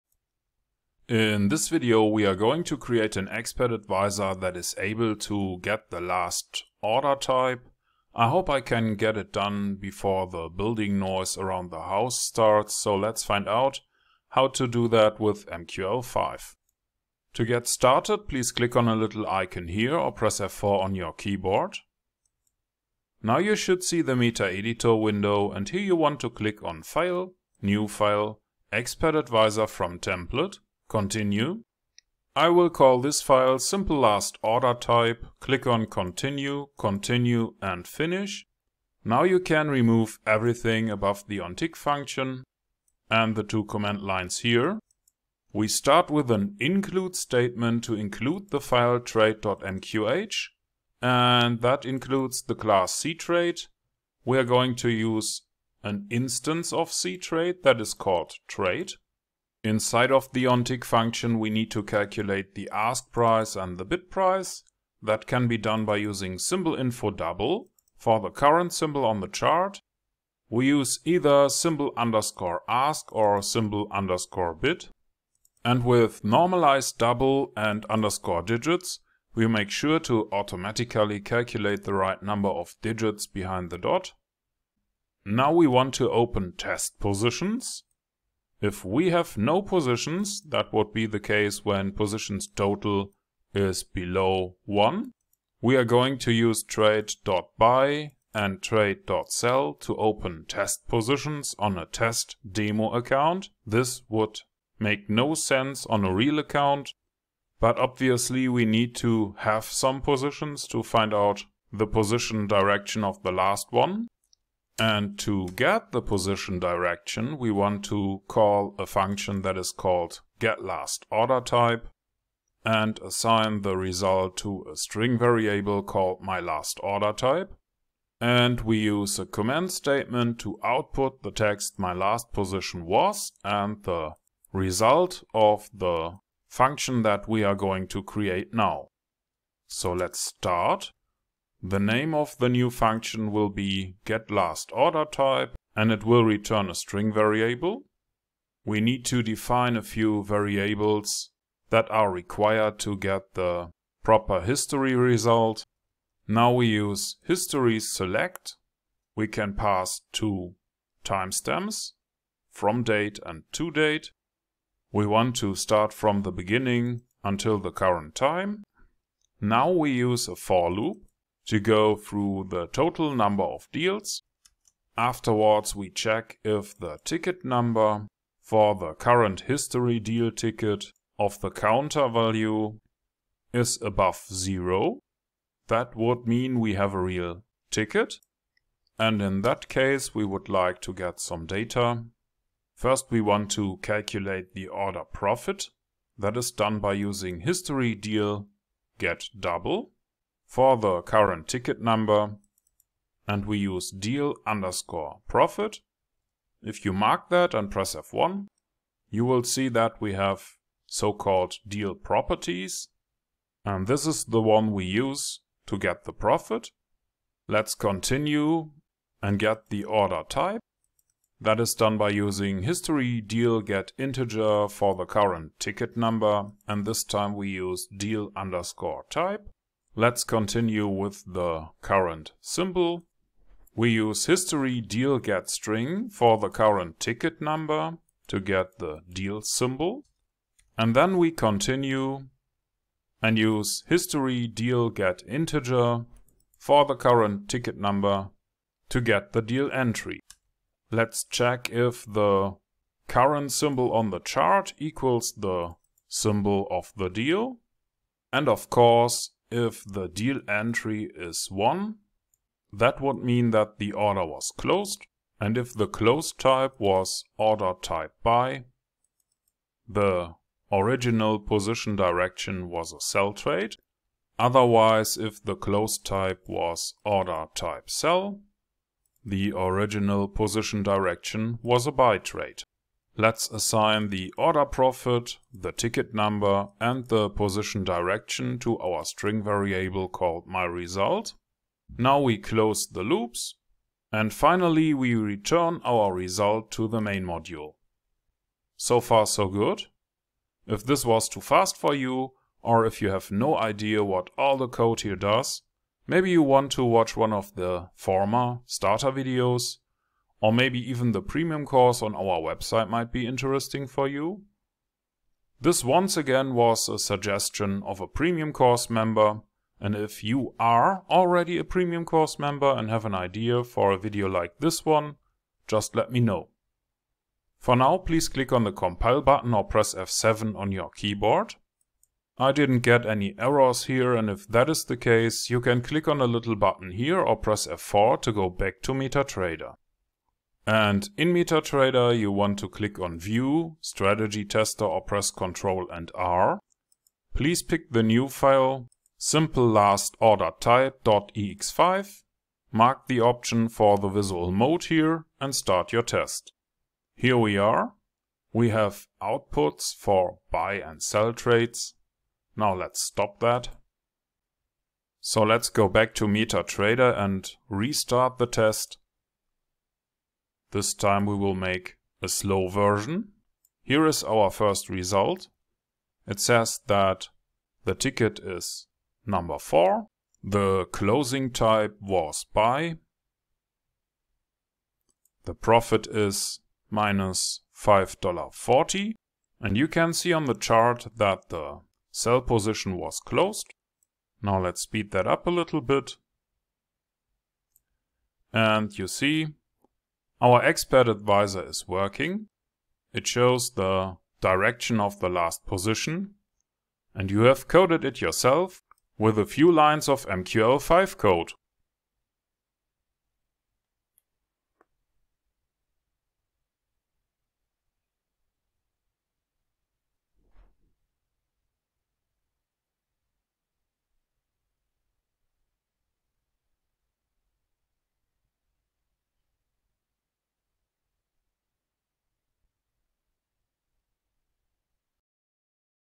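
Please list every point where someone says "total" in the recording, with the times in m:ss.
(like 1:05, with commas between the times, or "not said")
1:32, 2:52.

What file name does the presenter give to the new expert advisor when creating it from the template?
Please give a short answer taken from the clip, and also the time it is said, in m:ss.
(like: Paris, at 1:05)
simple last order type, at 0:33.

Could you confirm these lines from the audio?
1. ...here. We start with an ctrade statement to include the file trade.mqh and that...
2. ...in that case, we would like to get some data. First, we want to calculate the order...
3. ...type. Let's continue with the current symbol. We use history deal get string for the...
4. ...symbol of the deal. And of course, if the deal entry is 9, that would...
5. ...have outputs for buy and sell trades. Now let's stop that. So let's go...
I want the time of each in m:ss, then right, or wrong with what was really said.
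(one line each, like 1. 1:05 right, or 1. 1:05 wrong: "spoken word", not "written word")
1. 0:44 wrong: "include", not "ctrade"
2. 3:09 right
3. 3:49 right
4. 4:16 wrong: "1", not "9"
5. 5:58 right.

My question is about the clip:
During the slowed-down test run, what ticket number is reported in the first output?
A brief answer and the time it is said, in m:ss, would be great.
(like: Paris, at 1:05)
4, at 6:19.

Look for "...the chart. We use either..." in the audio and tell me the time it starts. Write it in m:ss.
1:09.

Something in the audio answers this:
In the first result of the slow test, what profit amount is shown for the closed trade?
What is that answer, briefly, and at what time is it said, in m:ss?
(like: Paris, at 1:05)
-$5.40, at 6:26.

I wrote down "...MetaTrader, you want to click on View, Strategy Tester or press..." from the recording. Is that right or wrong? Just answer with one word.
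right.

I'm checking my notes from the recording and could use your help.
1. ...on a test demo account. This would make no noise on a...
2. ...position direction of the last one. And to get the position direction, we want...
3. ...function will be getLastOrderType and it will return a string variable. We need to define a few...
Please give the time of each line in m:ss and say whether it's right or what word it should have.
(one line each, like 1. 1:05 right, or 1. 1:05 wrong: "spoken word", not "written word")
1. 1:41 wrong: "sense", not "noise"
2. 1:51 right
3. 2:22 right.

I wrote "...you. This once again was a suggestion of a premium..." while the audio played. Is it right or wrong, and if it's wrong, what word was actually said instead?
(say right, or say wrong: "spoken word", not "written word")
right.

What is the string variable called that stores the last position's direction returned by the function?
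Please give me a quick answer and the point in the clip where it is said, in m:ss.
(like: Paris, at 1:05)
myLastOrderType, at 2:06.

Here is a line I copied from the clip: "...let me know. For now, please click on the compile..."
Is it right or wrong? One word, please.
right.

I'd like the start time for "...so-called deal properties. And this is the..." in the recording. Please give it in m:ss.
3:30.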